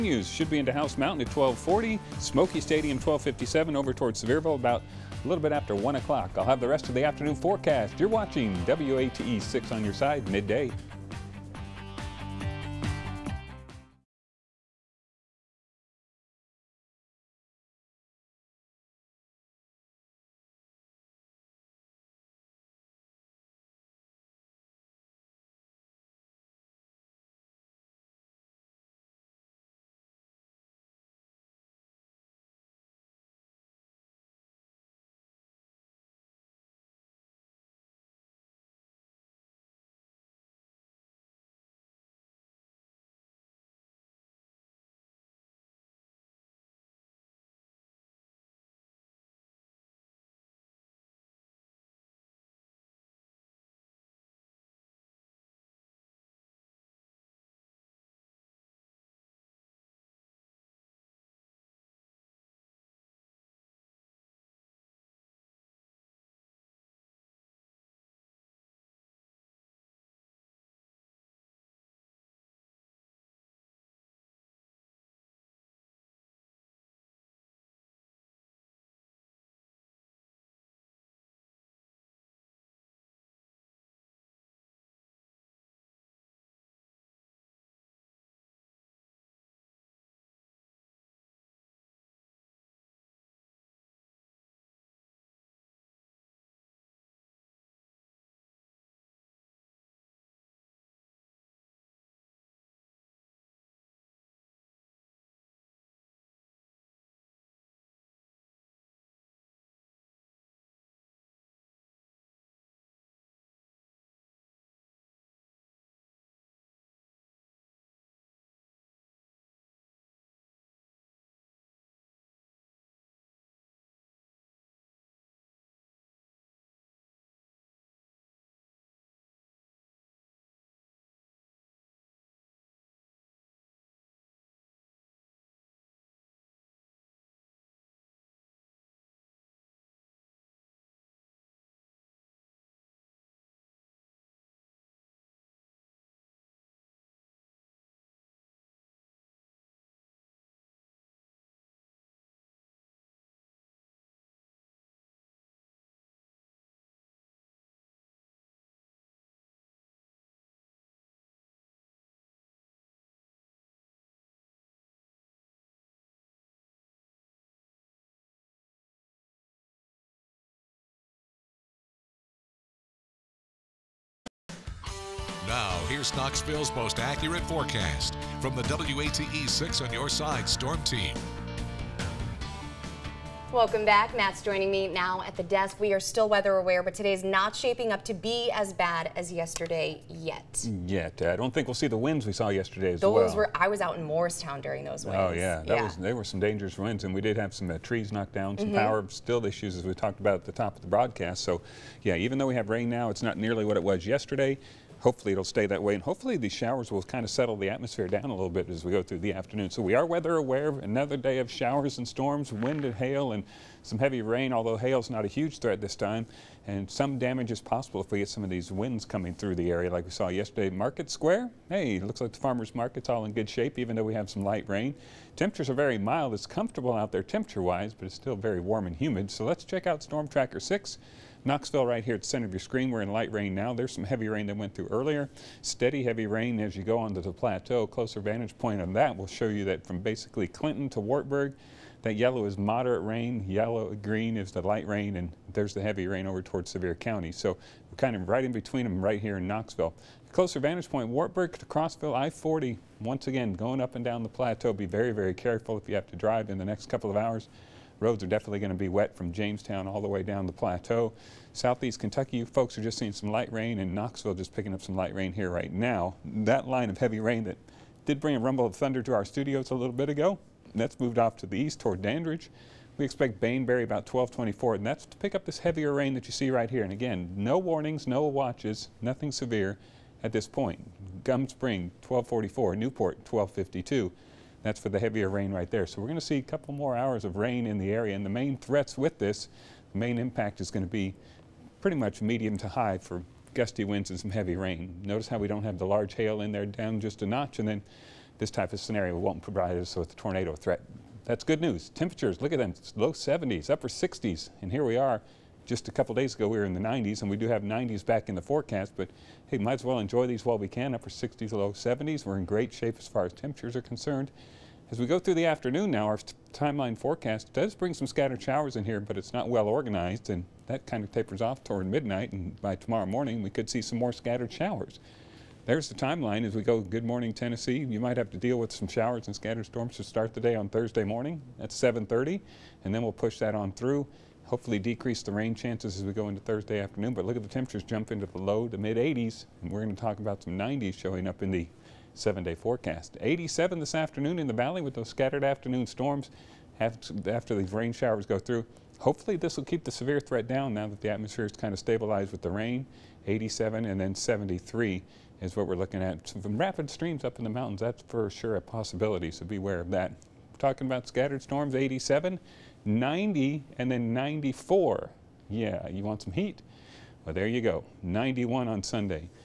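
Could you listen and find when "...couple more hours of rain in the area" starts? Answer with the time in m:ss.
4:46.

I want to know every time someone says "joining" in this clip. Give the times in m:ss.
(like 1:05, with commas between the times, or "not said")
3:04.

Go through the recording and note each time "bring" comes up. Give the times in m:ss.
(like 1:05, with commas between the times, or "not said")
4:28, 5:17.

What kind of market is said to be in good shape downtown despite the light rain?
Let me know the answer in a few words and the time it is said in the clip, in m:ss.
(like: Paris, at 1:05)
farmer's market, at 3:42.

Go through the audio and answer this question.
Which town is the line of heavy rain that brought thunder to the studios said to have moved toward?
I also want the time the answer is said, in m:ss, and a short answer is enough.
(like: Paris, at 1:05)
Dandridge, at 4:32.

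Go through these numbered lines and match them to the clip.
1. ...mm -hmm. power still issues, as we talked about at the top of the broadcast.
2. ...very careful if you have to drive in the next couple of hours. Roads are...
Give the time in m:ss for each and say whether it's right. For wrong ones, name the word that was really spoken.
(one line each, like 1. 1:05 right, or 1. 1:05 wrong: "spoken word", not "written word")
1. 3:18 right
2. 4:15 right.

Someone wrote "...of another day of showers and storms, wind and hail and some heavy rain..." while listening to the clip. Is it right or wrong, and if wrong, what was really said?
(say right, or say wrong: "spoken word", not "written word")
right.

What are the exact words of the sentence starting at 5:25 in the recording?
There's the timeline as we go good morning Tennessee.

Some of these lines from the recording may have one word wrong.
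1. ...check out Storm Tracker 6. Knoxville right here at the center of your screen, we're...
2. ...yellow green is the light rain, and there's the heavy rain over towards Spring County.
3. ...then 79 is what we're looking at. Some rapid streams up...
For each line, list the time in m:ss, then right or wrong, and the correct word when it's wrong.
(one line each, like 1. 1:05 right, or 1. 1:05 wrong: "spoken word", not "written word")
1. 3:49 right
2. 4:03 wrong: "Sevier", not "Spring"
3. 5:53 wrong: "73", not "79".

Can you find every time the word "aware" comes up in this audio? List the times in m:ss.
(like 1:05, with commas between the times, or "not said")
3:06, 3:30.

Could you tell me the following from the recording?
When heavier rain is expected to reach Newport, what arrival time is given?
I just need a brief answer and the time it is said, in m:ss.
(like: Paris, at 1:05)
12:52, at 4:43.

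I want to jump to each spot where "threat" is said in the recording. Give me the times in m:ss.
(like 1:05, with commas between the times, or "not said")
3:35, 4:48, 5:00, 5:50.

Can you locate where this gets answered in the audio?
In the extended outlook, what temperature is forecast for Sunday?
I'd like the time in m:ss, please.
6:08.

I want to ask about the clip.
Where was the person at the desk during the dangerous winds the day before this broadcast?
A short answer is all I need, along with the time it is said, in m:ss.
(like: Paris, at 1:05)
Morristown, at 3:14.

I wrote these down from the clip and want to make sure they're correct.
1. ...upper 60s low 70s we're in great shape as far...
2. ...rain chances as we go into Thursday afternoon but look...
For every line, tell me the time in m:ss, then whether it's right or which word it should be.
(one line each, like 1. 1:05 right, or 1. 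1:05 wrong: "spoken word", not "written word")
1. 5:10 right
2. 5:35 right.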